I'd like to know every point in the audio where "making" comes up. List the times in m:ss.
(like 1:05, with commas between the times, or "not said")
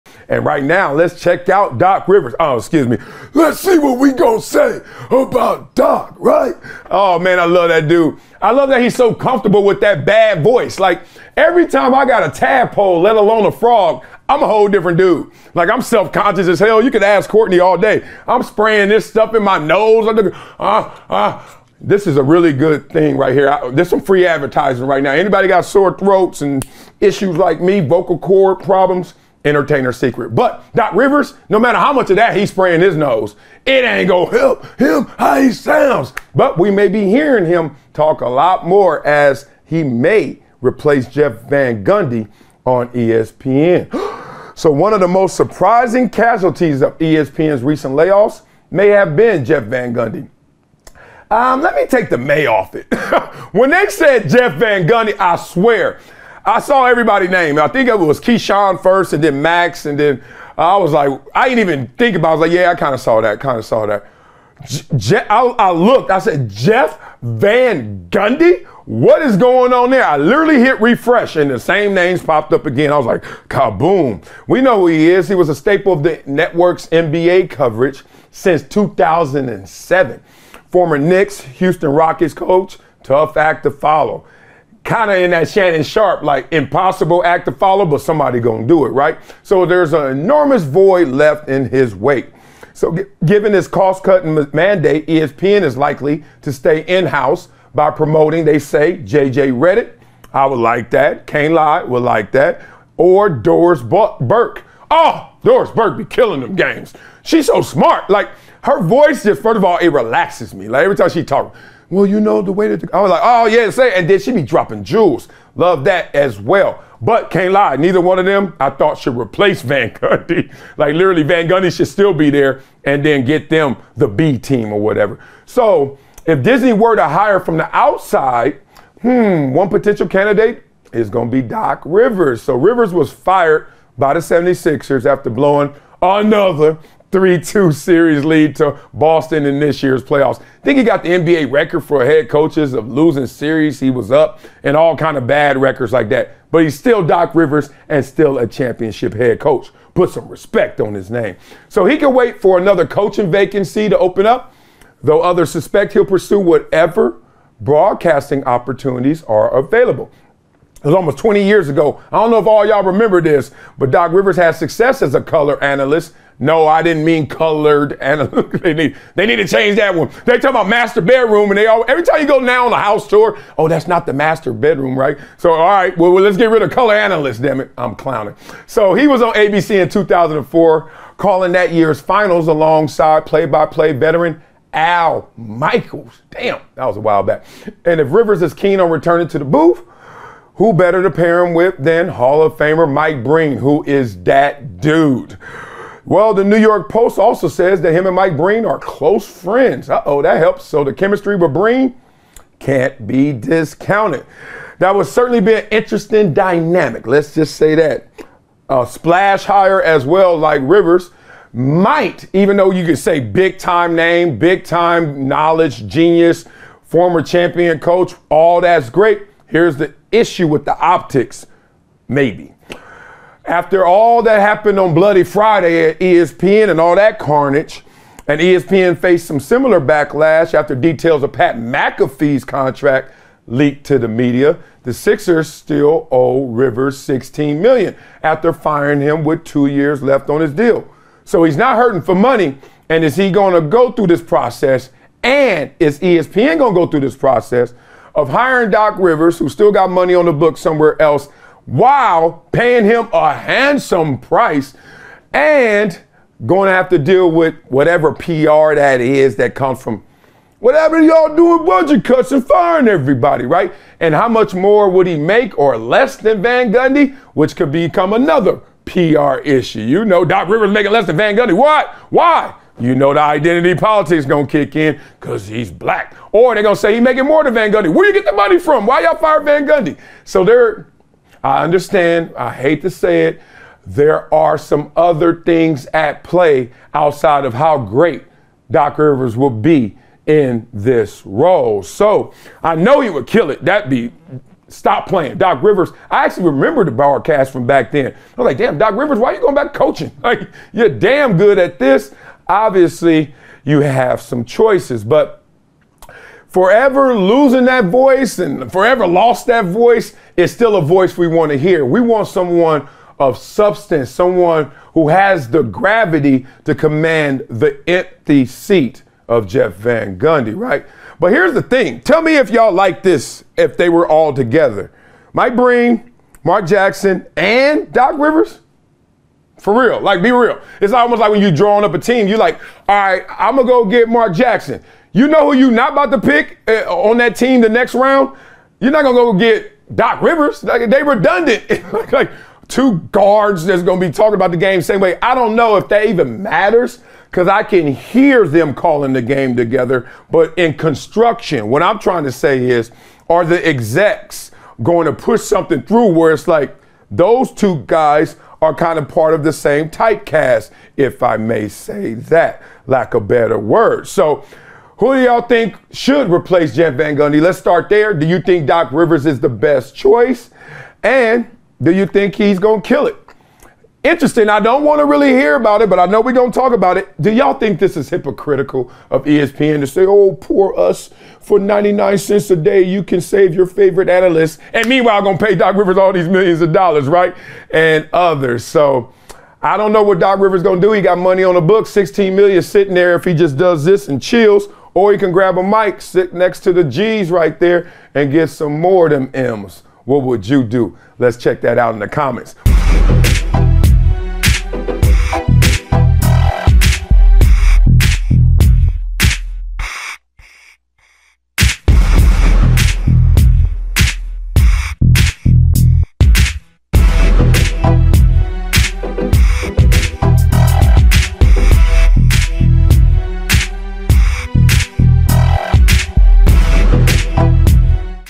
4:30, 4:36.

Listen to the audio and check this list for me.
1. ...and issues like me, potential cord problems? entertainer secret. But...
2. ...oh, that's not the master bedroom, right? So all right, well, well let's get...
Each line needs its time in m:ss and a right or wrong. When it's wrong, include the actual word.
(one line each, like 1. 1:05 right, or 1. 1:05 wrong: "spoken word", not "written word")
1. 0:26 wrong: "vocal", not "potential"
2. 2:53 right.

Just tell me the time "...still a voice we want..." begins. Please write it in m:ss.
5:10.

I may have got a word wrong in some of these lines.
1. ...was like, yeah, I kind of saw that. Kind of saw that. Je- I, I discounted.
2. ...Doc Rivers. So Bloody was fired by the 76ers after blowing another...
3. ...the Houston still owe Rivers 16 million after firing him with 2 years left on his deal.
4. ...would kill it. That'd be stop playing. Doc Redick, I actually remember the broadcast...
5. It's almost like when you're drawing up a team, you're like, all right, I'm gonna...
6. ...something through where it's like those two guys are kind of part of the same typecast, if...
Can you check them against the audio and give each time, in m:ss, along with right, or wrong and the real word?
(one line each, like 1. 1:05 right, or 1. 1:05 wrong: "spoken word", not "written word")
1. 1:02 wrong: "looked", not "discounted"
2. 2:11 wrong: "Rivers", not "Bloody"
3. 3:54 wrong: "Sixers", not "Houston"
4. 4:53 wrong: "Rivers", not "Redick"
5. 5:30 right
6. 5:55 right.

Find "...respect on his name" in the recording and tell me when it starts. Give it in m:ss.
2:30.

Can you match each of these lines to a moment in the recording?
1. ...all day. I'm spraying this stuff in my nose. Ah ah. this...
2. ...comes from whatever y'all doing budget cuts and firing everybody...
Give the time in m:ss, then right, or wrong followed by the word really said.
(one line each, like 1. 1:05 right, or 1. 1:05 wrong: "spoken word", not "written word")
1. 0:17 right
2. 4:19 right.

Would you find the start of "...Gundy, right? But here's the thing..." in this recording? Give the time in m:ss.
5:20.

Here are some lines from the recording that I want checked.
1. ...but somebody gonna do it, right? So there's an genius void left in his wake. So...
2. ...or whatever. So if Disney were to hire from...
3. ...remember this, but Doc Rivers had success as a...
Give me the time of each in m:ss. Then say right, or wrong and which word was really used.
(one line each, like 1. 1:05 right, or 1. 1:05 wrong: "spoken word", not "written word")
1. 1:27 wrong: "enormous", not "genius"
2. 2:04 right
3. 2:42 right.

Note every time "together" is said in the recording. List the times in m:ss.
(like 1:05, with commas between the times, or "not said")
5:24, 5:49.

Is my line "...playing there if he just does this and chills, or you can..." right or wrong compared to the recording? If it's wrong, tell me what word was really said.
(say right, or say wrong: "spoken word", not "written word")
wrong: "sitting", not "playing".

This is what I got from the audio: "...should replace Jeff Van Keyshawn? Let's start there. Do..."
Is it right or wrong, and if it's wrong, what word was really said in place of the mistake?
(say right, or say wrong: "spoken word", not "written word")
wrong: "Gundy", not "Keyshawn".